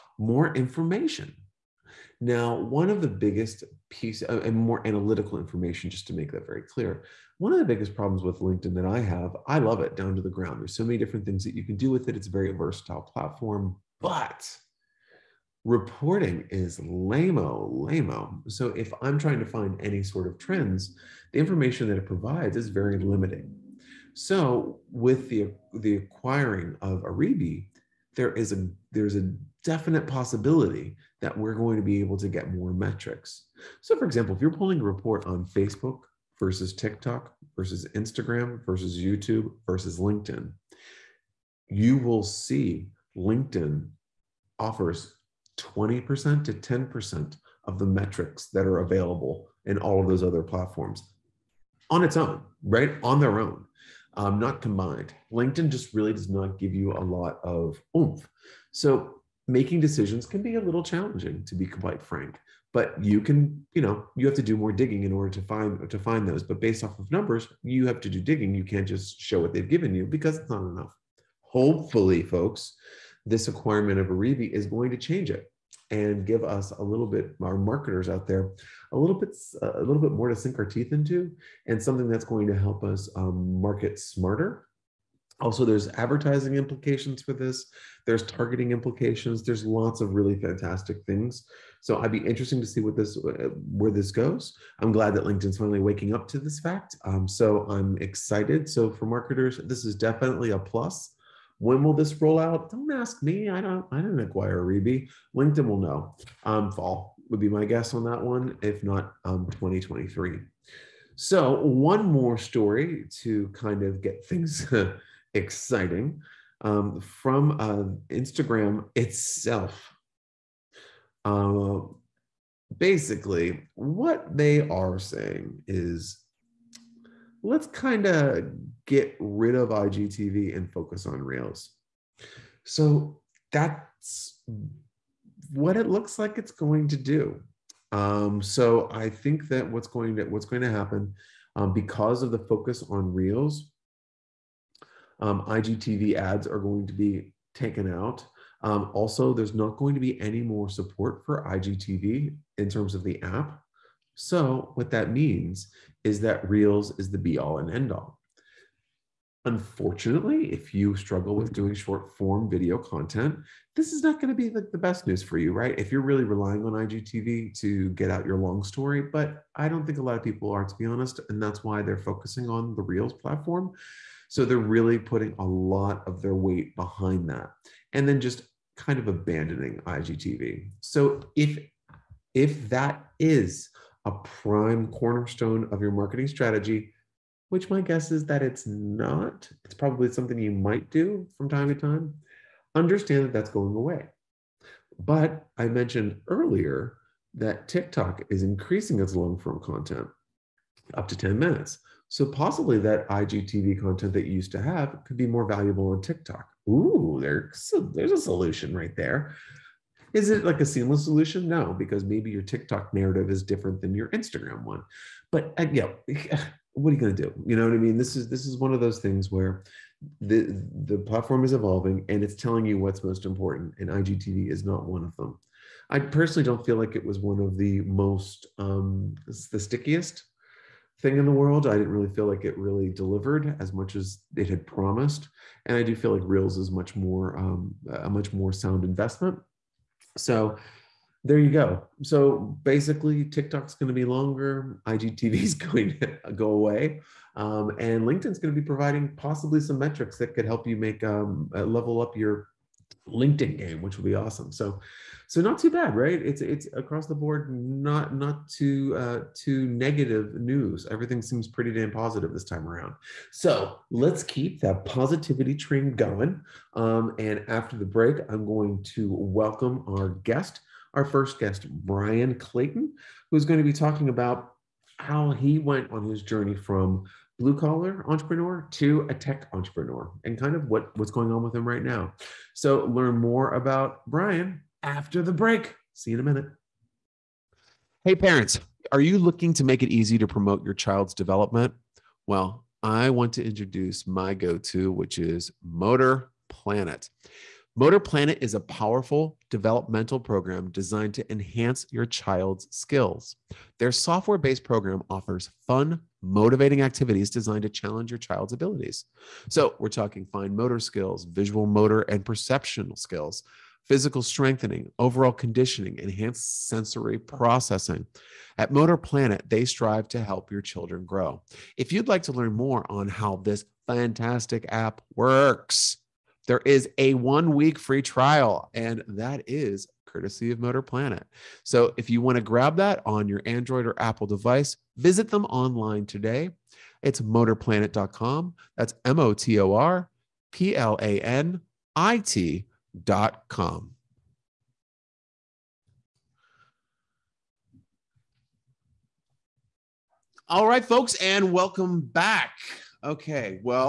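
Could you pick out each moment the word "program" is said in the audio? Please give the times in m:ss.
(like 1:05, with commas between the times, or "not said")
5:00, 5:04.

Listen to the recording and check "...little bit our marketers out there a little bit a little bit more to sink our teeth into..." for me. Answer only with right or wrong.
right.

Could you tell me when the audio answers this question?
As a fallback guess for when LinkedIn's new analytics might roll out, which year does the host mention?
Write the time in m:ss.
1:49.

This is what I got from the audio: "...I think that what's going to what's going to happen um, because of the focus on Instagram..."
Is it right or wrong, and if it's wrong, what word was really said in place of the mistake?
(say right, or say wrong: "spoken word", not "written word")
wrong: "Reels", not "Instagram".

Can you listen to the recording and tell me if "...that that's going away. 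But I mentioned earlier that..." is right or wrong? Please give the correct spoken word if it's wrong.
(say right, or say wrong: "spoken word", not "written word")
right.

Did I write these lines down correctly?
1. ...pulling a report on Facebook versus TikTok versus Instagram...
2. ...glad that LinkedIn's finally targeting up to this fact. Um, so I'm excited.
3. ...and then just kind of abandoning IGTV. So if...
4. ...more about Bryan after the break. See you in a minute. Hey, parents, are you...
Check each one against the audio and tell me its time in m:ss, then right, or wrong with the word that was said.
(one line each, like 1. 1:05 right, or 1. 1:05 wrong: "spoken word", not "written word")
1. 0:34 right
2. 1:34 wrong: "waking", not "targeting"
3. 2:57 right
4. 4:43 right.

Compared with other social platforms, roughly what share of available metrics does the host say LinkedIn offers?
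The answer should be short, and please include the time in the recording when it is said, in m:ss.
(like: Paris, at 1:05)
20% to 10%, at 0:45.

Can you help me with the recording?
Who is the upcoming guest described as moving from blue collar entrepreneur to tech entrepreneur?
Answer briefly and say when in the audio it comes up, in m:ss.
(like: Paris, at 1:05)
Bryan Clayton, at 4:31.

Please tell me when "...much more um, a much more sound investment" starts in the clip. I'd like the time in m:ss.
3:56.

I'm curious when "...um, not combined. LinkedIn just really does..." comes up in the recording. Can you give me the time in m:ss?
0:54.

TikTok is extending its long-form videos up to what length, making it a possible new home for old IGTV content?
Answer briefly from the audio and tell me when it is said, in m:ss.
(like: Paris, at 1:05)
10 minutes, at 3:21.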